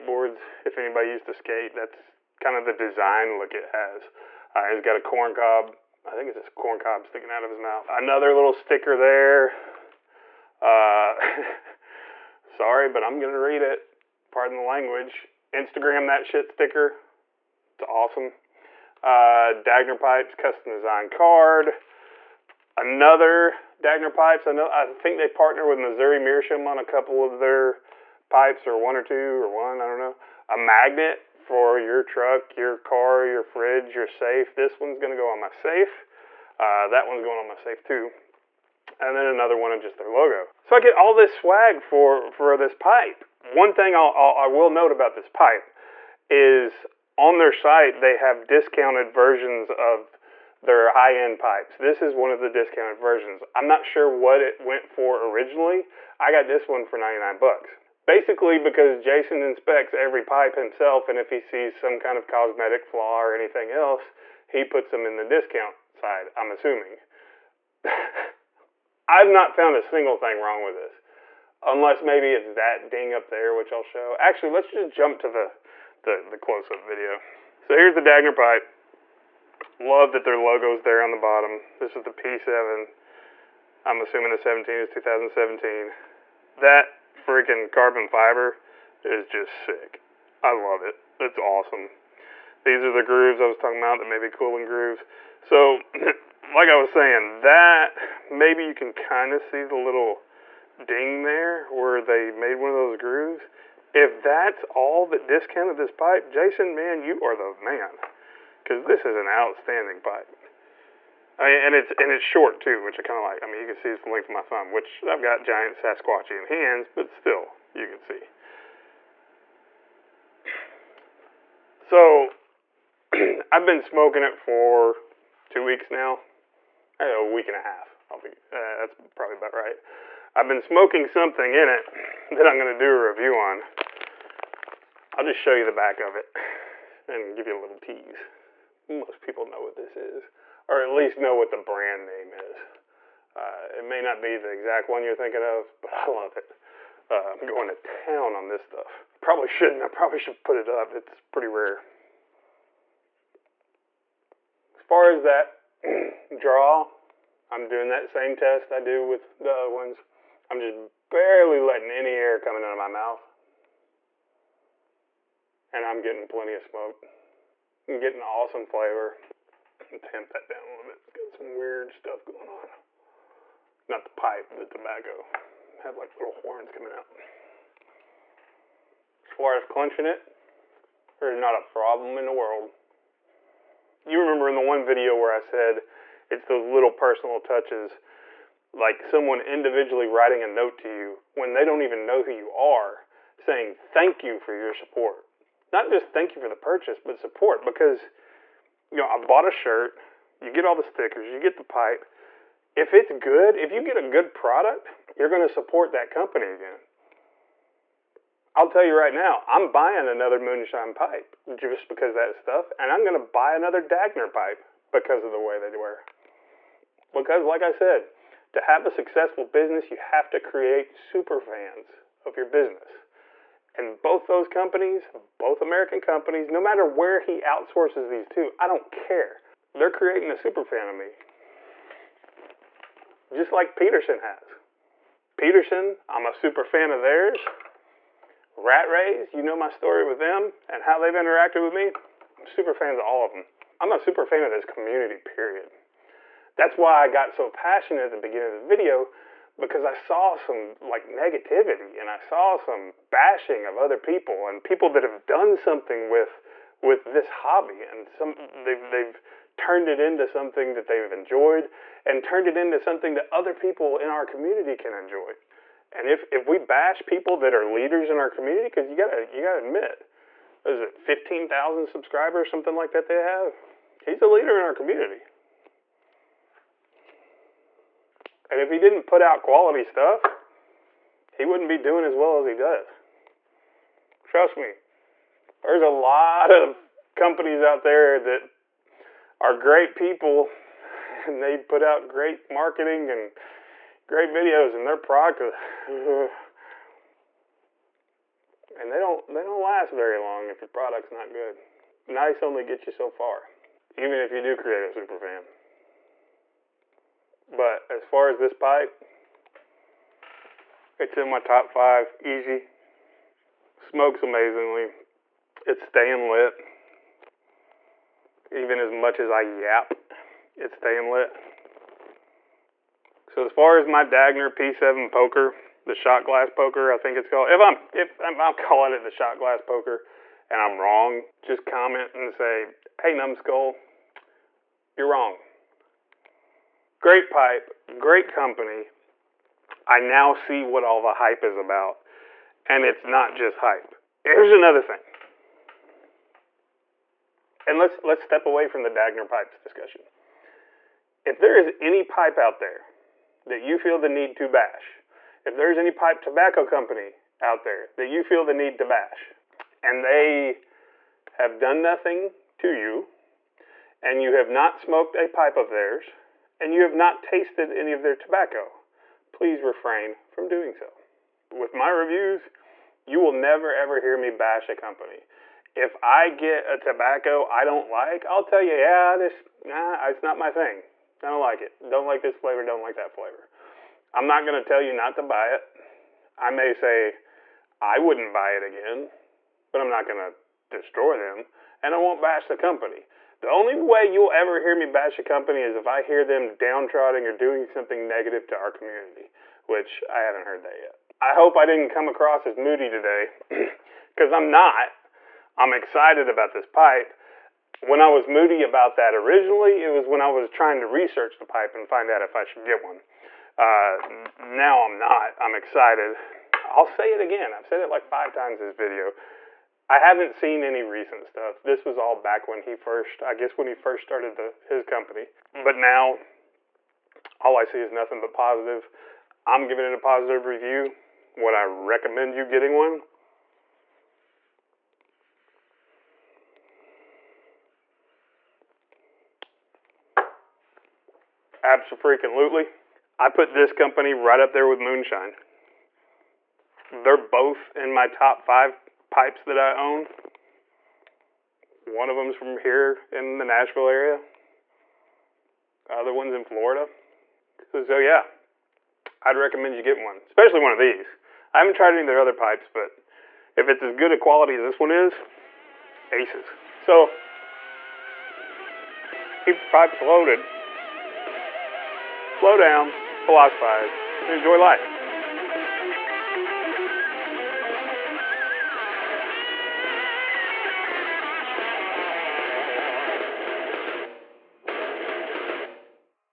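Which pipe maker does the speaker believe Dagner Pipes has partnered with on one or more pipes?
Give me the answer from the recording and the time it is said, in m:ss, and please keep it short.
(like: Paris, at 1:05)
Missouri Meerschaum, at 0:25.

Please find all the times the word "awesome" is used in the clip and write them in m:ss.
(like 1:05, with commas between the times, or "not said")
0:17, 1:31, 2:48.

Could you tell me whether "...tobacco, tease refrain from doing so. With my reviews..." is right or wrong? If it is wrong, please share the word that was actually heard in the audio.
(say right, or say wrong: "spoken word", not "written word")
wrong: "please", not "tease".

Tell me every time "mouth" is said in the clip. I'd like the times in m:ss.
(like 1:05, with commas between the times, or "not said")
0:07, 2:42.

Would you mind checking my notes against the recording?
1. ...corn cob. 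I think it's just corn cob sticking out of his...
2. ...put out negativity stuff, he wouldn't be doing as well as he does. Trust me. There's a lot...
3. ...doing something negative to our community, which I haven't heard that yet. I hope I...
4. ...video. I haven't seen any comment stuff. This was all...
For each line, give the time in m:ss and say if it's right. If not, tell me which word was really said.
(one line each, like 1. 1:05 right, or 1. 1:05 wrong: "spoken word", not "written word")
1. 0:04 right
2. 4:39 wrong: "quality", not "negativity"
3. 6:37 right
4. 6:58 wrong: "recent", not "comment".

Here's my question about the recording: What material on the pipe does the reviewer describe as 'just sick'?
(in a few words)
Carbon fiber.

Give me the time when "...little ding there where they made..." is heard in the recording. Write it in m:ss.
1:39.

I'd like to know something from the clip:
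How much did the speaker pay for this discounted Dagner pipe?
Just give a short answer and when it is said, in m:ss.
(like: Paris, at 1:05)
$99, at 0:56.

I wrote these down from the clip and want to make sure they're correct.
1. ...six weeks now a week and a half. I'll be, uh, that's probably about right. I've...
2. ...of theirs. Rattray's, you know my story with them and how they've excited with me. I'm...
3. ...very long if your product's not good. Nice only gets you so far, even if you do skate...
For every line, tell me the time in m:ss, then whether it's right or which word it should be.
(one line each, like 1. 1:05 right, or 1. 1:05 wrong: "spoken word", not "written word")
1. 2:05 wrong: "two", not "six"
2. 3:56 wrong: "interacted", not "excited"
3. 4:59 wrong: "create", not "skate".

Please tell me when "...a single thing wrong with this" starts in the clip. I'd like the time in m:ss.
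1:09.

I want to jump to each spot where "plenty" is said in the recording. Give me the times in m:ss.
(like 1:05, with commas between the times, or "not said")
2:46.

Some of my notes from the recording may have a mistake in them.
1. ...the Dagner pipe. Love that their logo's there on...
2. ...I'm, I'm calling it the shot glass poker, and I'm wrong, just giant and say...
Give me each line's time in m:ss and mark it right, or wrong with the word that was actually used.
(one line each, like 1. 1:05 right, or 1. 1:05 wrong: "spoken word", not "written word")
1. 1:17 right
2. 5:28 wrong: "comment", not "giant".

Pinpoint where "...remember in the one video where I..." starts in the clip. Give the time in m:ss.
3:04.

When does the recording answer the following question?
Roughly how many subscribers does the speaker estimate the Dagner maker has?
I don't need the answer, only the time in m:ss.
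4:30.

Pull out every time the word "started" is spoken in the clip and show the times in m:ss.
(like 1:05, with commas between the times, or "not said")
7:04.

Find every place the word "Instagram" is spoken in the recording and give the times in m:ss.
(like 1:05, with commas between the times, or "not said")
0:15.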